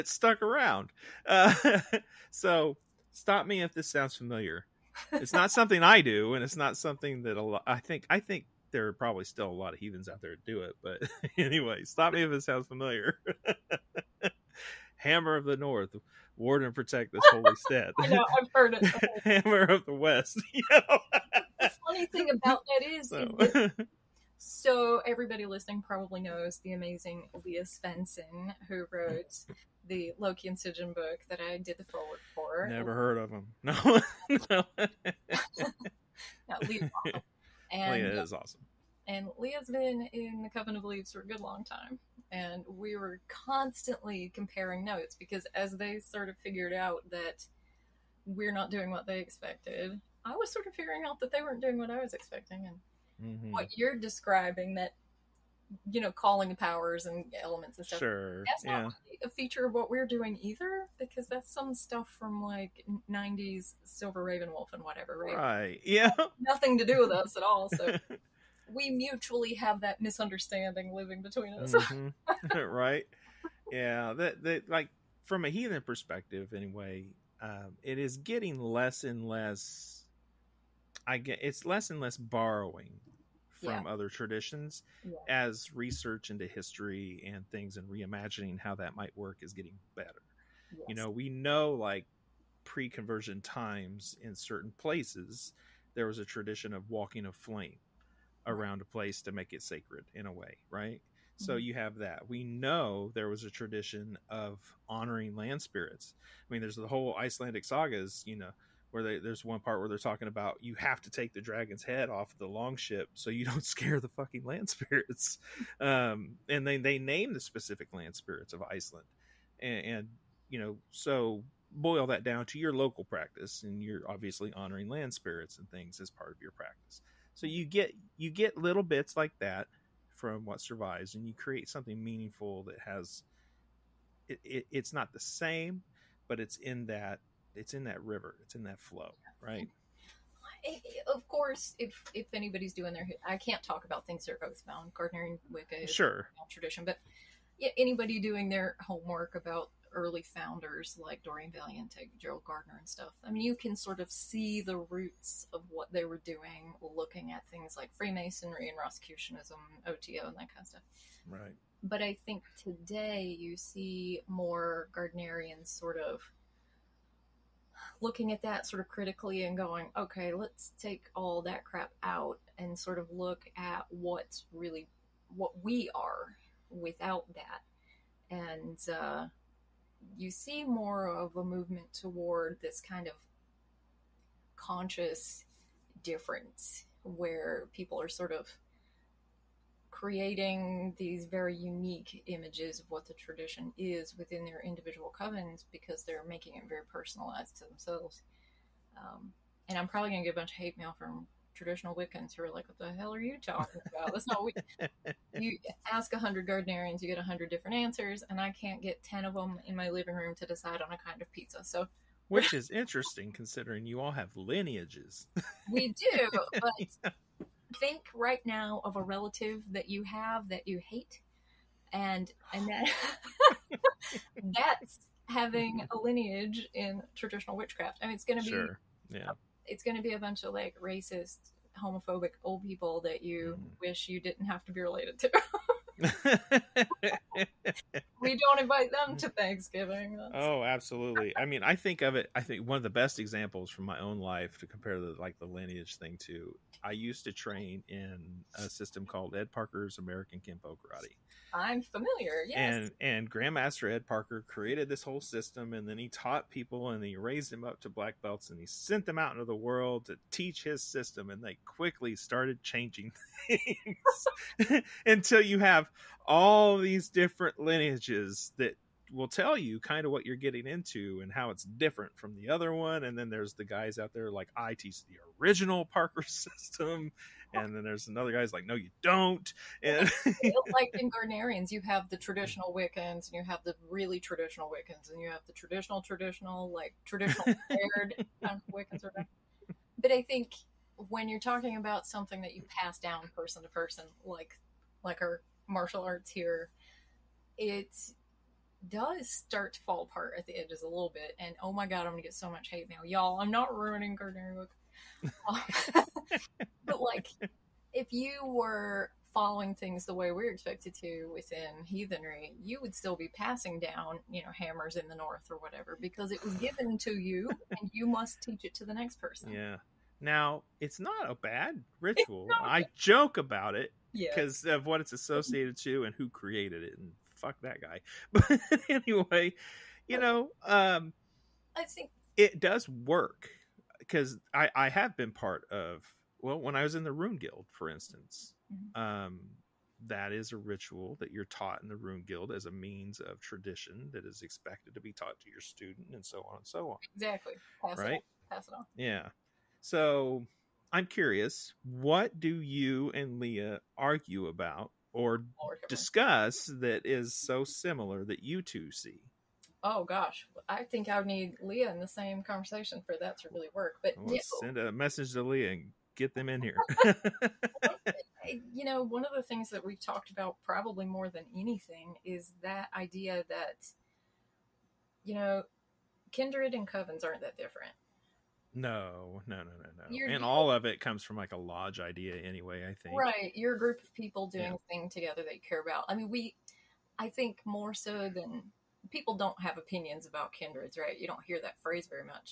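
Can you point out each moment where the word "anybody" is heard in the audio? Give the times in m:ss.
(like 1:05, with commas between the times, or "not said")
2:22, 2:27.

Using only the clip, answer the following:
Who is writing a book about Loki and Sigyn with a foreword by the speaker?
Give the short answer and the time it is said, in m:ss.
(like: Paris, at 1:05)
Leah Svendsen, at 0:27.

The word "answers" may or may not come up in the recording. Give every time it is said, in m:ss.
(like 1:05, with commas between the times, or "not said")
3:27.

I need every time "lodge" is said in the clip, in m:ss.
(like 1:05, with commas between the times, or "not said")
6:21.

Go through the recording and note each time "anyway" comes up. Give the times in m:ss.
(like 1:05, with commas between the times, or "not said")
0:11, 1:16, 5:28, 6:22.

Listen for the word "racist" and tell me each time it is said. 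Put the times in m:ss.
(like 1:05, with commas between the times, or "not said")
3:50.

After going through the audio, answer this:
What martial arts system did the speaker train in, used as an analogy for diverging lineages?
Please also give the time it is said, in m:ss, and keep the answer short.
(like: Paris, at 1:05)
Ed Parker's American Kenpo Karate, at 4:09.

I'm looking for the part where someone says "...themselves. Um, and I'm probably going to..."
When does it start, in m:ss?
3:17.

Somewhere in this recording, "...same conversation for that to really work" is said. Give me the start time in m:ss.
6:02.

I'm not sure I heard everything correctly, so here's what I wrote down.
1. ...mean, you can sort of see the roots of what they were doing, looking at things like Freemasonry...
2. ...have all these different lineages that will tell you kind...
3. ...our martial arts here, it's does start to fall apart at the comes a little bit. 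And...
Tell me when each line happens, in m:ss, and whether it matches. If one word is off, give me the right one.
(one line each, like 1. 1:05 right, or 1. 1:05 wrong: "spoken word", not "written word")
1. 2:33 right
2. 4:25 right
3. 4:55 wrong: "edges", not "comes".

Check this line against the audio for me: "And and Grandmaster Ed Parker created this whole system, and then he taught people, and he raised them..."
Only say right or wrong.
right.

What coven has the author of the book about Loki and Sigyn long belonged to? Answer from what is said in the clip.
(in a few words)
Coven of Leaves.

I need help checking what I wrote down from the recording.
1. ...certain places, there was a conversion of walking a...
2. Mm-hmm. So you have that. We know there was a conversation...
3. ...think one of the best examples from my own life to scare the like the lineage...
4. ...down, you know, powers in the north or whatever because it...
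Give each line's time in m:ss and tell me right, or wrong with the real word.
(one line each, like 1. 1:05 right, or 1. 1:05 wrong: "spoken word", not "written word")
1. 1:34 wrong: "tradition", not "conversion"
2. 1:41 wrong: "tradition", not "conversation"
3. 4:02 wrong: "compare", not "scare"
4. 5:13 wrong: "hammers", not "powers".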